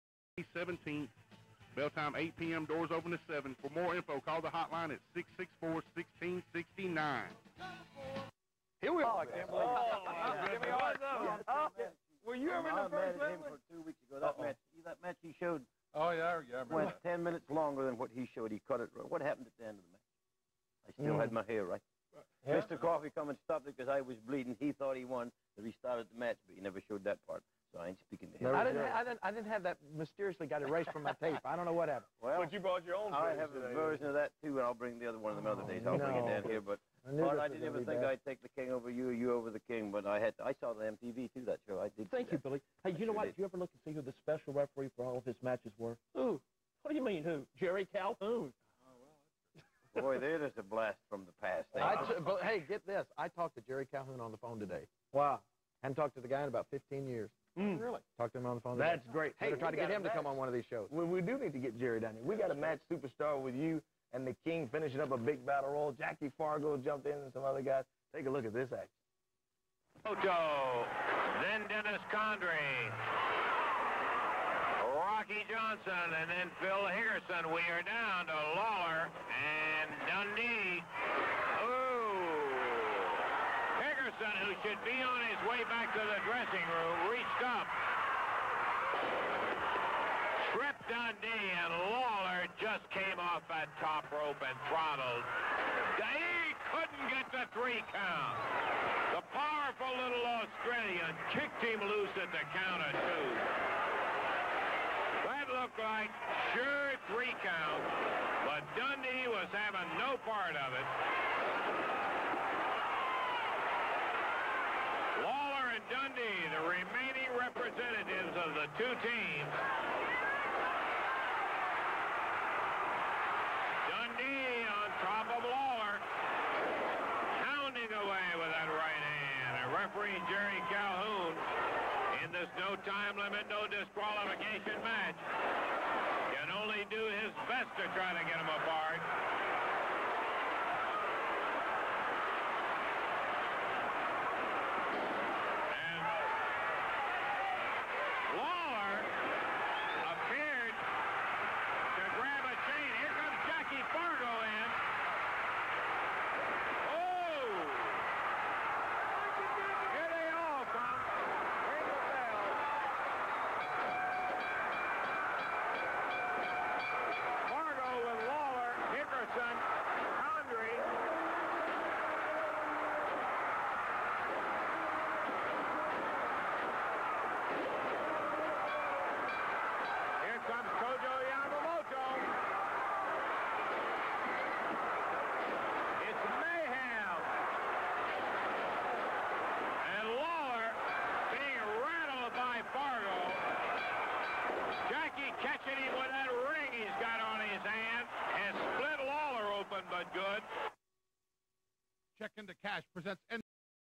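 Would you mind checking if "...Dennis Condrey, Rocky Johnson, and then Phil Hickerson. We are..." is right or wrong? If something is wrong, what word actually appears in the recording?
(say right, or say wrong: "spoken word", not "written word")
right.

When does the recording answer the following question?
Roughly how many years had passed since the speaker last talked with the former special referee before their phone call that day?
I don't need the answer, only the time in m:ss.
0:56.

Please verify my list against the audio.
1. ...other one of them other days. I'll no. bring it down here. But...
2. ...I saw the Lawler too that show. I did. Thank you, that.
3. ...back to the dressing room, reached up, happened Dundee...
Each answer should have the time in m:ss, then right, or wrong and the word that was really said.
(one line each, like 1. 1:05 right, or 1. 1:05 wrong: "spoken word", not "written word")
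1. 0:35 right
2. 0:40 wrong: "MTV", not "Lawler"
3. 1:25 wrong: "tripped", not "happened".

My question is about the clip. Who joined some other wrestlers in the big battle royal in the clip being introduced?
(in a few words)
Jackie Fargo.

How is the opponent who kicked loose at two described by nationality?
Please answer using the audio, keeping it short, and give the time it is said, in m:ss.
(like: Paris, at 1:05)
Australian, at 1:40.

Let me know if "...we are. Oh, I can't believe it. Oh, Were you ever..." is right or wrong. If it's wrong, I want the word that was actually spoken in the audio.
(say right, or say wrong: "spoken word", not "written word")
right.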